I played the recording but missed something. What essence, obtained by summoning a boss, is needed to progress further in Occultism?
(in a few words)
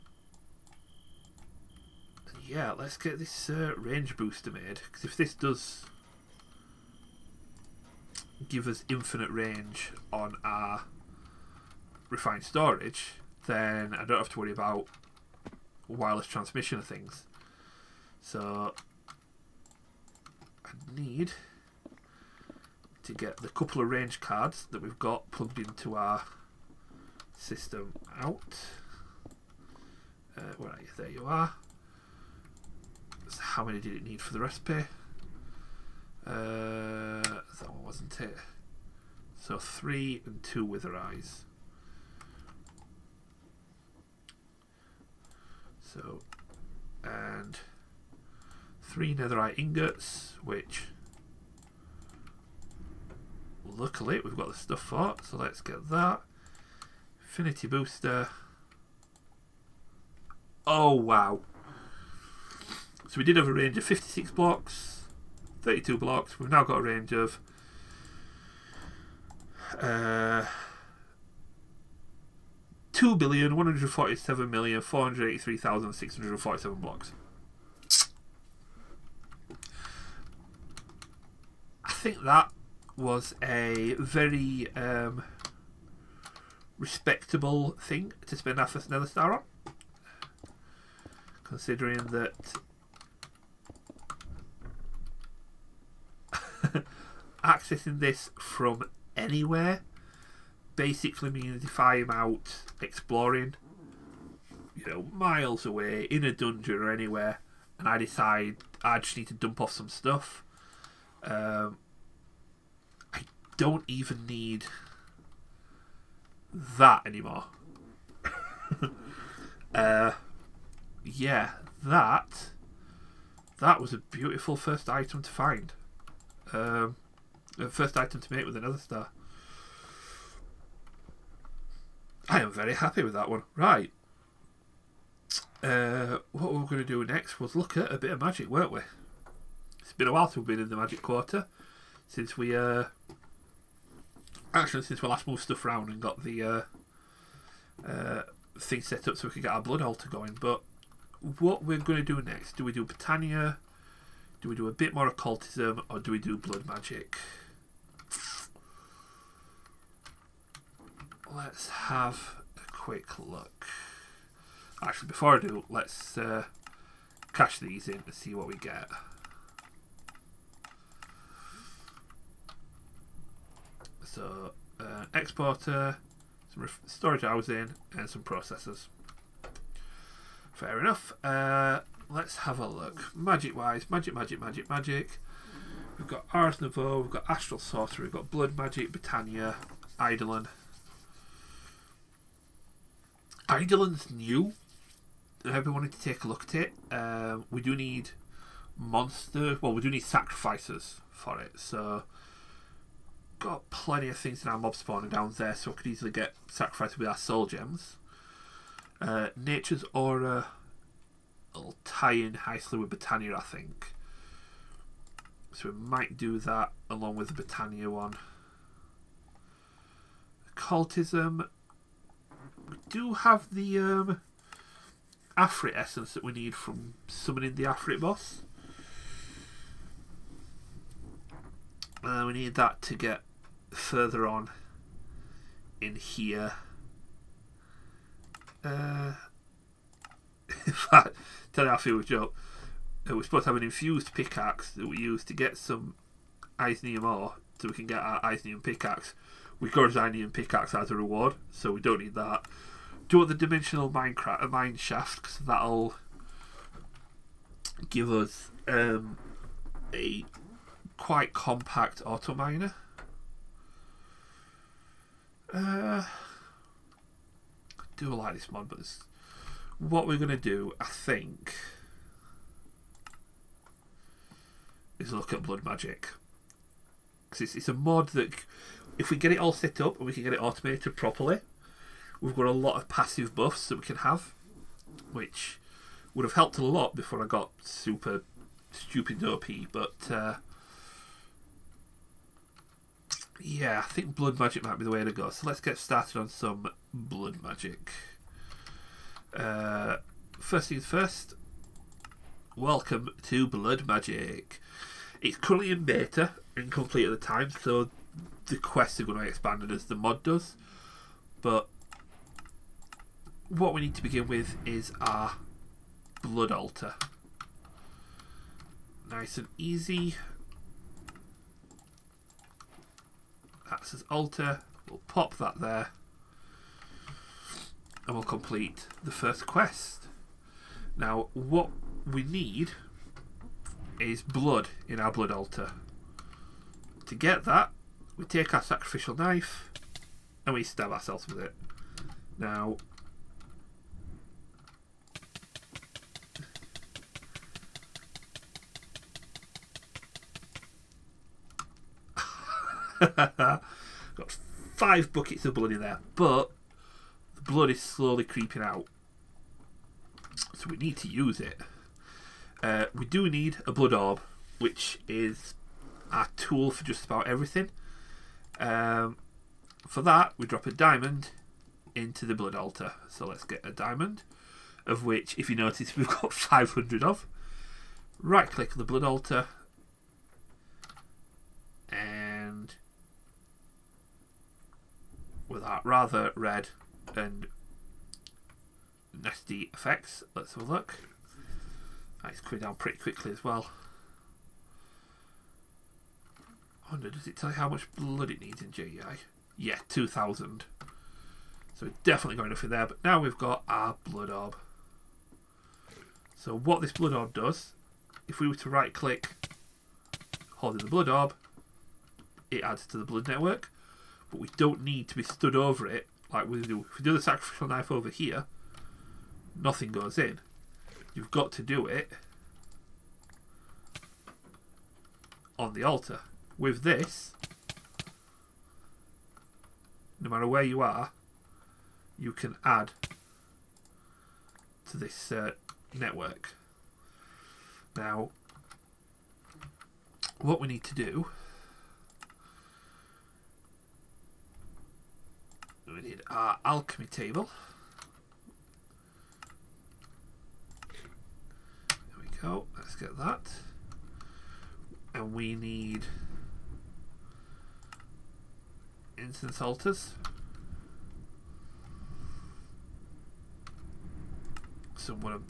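Afrit essence.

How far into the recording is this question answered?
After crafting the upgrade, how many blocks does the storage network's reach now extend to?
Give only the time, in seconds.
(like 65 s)
72 s.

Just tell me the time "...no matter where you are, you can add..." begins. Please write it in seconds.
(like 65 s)
430 s.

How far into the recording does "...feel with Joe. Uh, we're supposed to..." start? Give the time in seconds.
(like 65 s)
241 s.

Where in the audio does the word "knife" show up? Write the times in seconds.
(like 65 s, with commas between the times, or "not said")
339 s, 417 s.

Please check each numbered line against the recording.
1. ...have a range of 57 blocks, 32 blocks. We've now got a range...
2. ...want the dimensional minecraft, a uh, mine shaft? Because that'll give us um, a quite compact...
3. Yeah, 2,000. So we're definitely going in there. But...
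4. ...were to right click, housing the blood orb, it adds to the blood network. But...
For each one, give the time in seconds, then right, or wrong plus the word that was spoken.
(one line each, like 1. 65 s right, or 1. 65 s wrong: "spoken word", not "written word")
1. 63 s wrong: "56", not "57"
2. 253 s right
3. 399 s right
4. 408 s wrong: "holding", not "housing".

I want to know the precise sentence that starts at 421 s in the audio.
You've got to do it on the altar.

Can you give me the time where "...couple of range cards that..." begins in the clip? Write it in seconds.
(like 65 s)
23 s.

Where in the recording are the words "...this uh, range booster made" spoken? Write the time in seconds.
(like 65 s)
3 s.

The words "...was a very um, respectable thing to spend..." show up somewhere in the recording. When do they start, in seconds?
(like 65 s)
82 s.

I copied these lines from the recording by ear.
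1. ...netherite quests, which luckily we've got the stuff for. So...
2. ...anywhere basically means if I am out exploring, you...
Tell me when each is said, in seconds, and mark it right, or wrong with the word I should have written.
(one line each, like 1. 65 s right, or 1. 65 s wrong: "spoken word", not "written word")
1. 49 s wrong: "ingots", not "quests"
2. 99 s right.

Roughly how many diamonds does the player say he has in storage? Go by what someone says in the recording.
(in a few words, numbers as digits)
500.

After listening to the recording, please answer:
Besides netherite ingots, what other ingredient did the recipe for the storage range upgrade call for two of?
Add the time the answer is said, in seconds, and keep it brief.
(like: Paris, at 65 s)
wither eyes, at 40 s.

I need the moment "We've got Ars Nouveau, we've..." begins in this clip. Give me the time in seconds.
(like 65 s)
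185 s.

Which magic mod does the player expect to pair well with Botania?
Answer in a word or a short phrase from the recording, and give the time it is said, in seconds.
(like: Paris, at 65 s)
Nature's Aura, at 209 s.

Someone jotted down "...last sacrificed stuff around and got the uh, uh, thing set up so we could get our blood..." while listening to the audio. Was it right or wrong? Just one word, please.
wrong.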